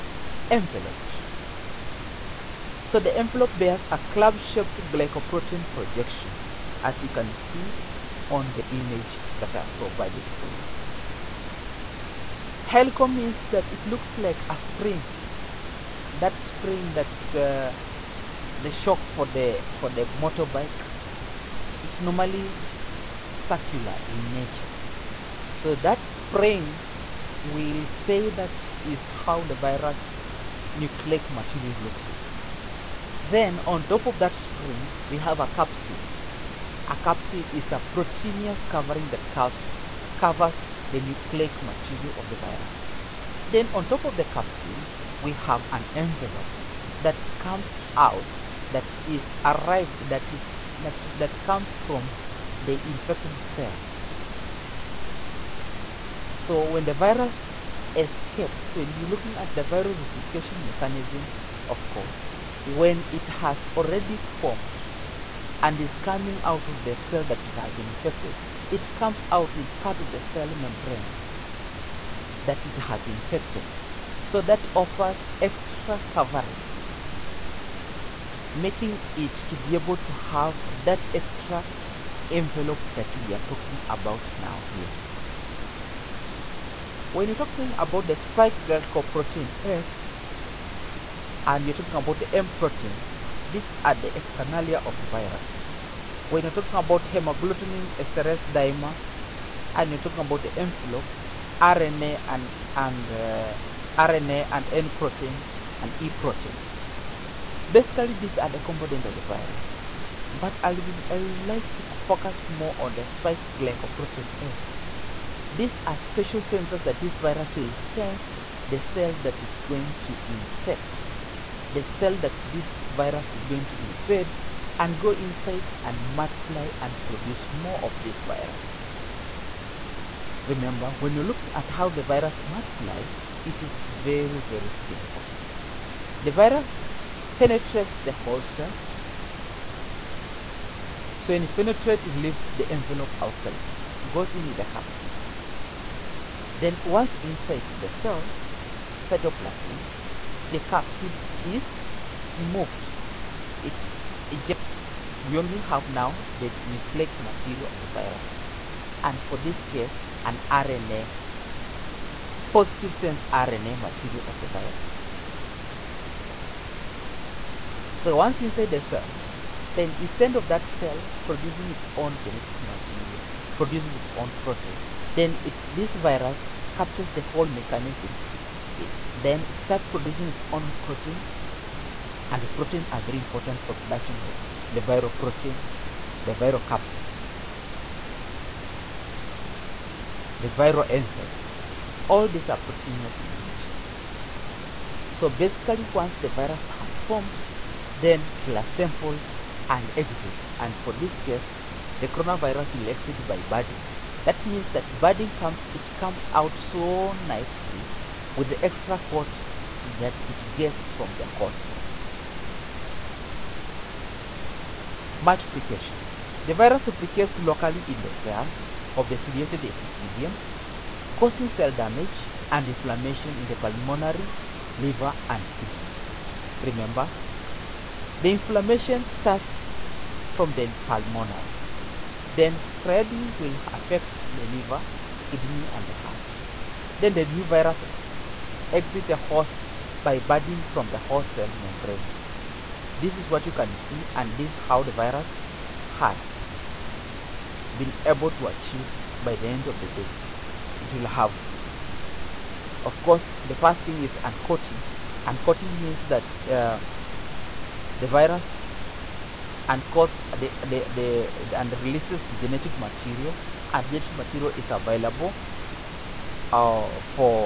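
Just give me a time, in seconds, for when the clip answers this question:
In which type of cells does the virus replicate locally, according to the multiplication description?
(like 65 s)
219 s.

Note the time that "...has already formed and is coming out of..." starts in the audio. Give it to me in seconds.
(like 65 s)
63 s.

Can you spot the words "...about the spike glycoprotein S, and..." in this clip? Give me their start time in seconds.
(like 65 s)
87 s.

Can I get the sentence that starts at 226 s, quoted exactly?
Remember, the inflammation starts from the pulmonary, then spreading will affect the liver, kidney, and the heart.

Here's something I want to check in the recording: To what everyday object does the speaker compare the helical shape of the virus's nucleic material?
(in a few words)
A spring.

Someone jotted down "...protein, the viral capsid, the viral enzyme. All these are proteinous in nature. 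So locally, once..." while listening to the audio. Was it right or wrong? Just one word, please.
wrong.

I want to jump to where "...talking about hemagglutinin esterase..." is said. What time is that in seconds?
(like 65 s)
96 s.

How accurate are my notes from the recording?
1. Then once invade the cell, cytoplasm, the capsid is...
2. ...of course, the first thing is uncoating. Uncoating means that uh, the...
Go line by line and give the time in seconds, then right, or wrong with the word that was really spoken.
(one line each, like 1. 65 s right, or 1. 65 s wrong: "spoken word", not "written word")
1. 146 s wrong: "inside", not "invade"
2. 252 s right.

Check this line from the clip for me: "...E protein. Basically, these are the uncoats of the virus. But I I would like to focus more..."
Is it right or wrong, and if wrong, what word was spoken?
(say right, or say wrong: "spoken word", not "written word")
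wrong: "components", not "uncoats".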